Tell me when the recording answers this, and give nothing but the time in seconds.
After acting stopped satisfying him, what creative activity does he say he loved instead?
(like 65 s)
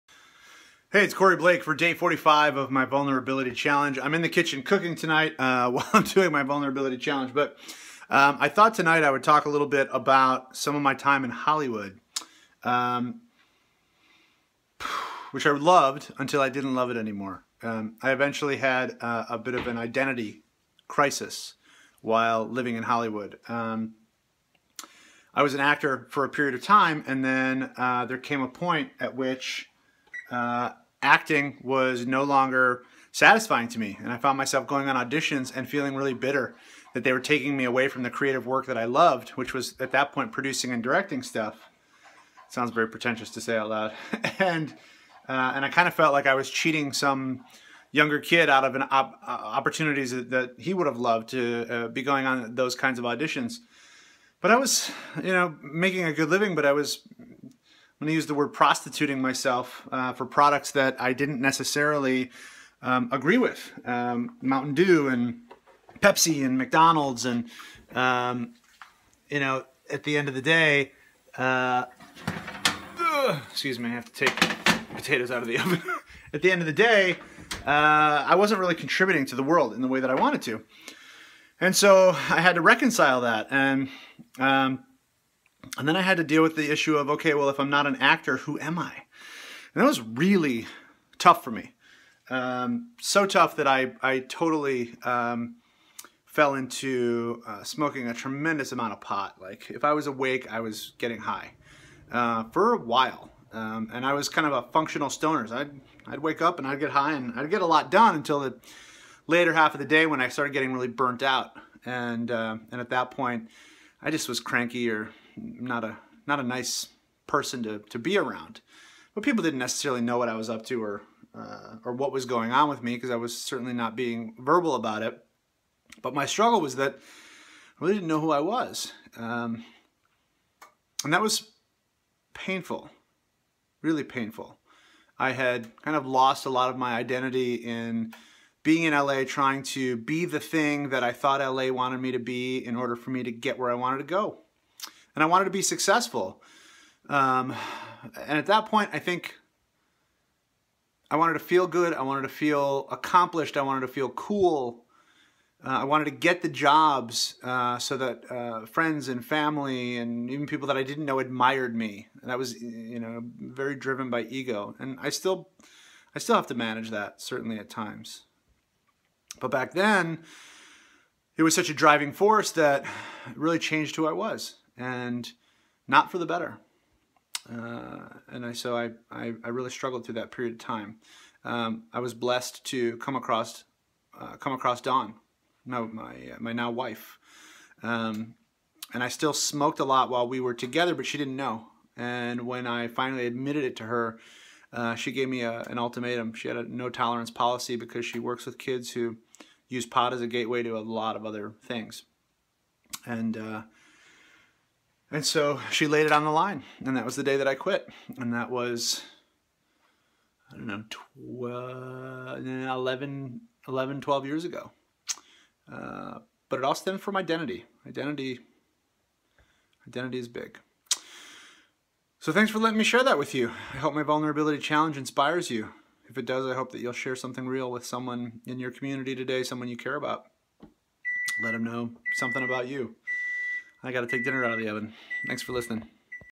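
40 s.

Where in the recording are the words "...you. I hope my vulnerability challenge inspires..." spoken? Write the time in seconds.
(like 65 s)
223 s.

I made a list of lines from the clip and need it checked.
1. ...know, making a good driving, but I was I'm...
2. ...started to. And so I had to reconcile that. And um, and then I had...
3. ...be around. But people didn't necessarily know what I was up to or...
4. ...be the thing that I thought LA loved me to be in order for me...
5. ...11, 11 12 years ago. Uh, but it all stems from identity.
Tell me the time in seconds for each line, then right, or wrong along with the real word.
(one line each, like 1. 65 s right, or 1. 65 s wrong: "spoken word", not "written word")
1. 55 s wrong: "living", not "driving"
2. 80 s wrong: "wanted", not "started"
3. 117 s right
4. 139 s wrong: "wanted", not "loved"
5. 212 s right.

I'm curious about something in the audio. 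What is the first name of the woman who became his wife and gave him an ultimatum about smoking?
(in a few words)
Dawn.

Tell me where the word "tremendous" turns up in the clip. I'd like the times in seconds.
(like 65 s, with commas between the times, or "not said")
98 s.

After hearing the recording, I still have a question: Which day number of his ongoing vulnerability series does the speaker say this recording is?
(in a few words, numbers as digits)
45.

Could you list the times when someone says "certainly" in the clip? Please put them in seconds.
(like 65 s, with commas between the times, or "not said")
123 s, 167 s.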